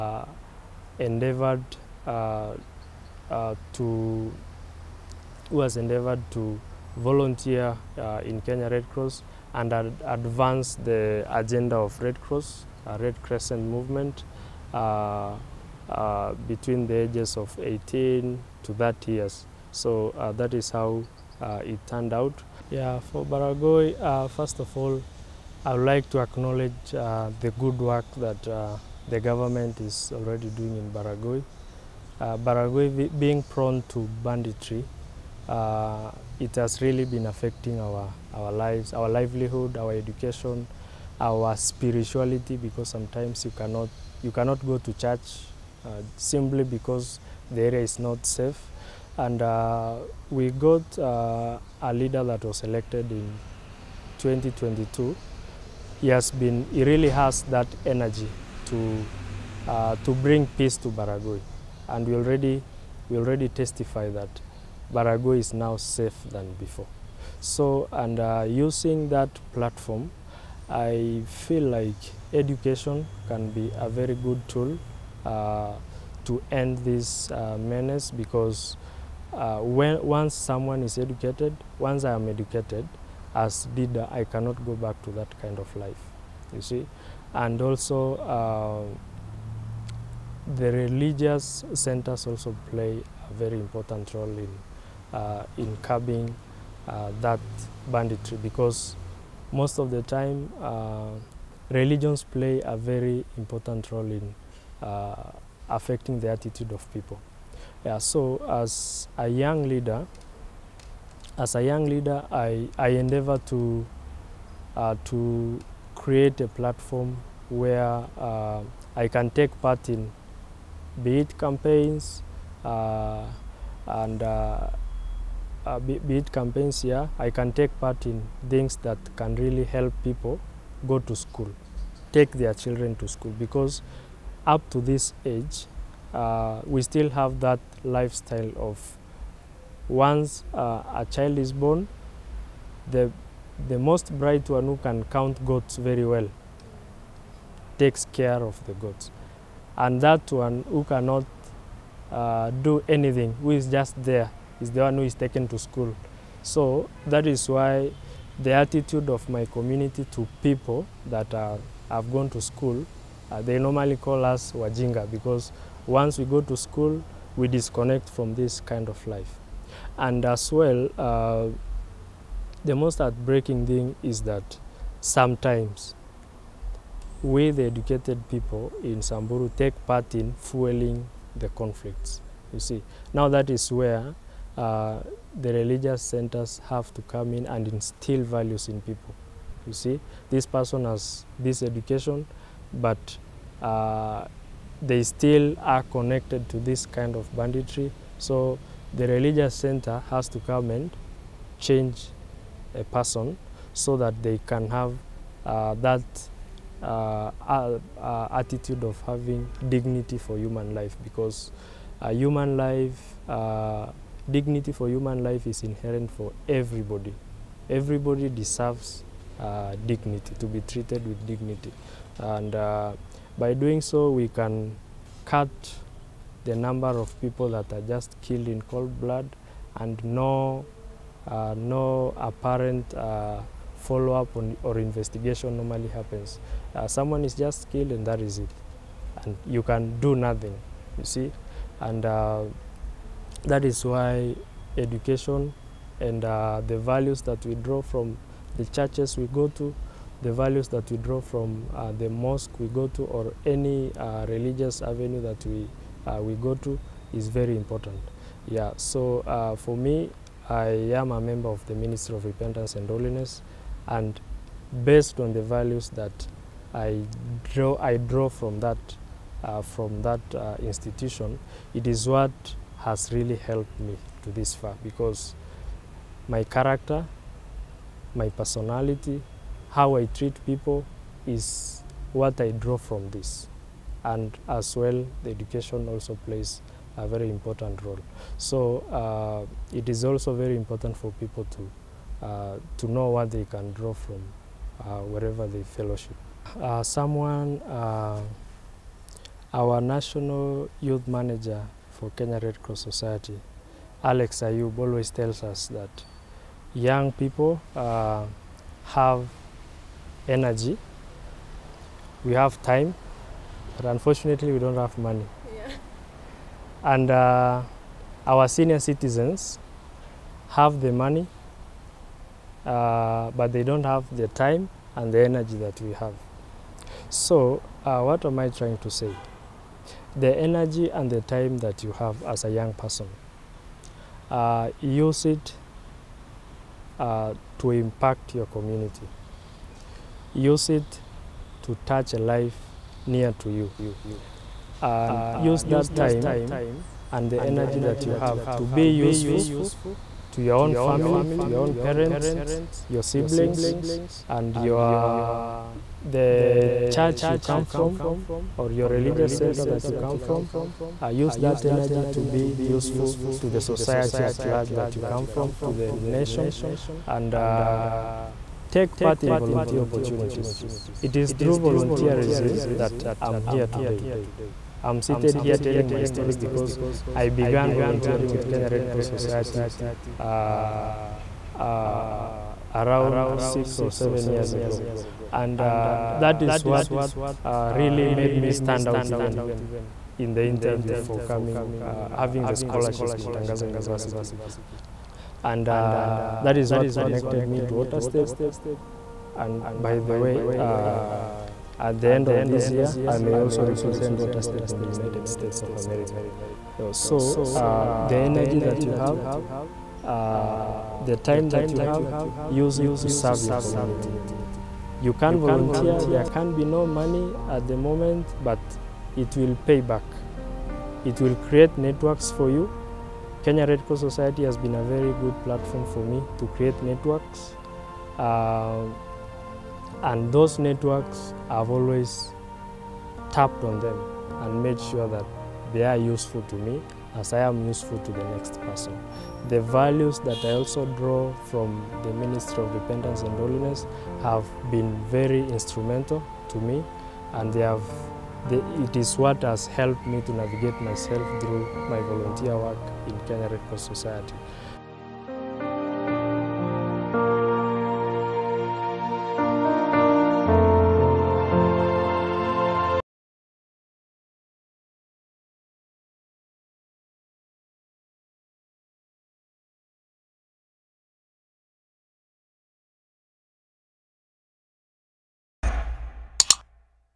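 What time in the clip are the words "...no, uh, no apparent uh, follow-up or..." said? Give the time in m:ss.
3:50.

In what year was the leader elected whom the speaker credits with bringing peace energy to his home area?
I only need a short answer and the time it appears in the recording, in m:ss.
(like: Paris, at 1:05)
2022, at 0:54.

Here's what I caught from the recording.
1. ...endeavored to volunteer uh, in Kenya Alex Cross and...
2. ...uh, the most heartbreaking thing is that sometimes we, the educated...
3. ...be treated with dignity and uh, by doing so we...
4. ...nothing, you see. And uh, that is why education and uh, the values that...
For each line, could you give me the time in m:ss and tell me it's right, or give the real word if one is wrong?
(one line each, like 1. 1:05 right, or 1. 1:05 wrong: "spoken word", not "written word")
1. 0:05 wrong: "Red", not "Alex"
2. 2:50 right
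3. 3:40 right
4. 4:00 right.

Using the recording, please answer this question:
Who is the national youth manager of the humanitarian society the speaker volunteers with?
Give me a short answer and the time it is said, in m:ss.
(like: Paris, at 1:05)
Alex Ayub, at 5:04.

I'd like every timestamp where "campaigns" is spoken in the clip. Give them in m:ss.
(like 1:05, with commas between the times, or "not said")
2:01, 2:06.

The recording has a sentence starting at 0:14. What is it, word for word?
Uh, uh, between the ages of 18 to 30 years.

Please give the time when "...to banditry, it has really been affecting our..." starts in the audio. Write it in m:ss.
0:33.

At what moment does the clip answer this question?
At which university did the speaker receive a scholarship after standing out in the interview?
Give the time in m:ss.
6:33.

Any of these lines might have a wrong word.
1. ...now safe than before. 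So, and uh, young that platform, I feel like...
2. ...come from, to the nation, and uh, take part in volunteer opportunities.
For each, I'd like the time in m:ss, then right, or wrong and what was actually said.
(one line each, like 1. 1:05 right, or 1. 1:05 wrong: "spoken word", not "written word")
1. 1:05 wrong: "using", not "young"
2. 6:05 right.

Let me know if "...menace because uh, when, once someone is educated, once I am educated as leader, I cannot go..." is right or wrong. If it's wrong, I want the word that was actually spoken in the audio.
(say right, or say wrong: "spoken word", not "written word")
right.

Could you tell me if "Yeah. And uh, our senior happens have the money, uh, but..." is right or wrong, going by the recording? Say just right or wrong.
wrong.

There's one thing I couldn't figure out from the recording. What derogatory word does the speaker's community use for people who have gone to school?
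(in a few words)
Wajinga.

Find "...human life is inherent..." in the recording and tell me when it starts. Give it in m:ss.
3:34.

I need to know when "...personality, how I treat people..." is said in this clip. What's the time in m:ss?
4:38.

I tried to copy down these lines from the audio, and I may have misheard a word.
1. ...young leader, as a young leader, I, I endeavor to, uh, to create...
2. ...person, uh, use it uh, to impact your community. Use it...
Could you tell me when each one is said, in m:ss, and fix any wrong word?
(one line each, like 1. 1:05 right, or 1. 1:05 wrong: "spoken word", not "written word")
1. 1:49 right
2. 5:32 right.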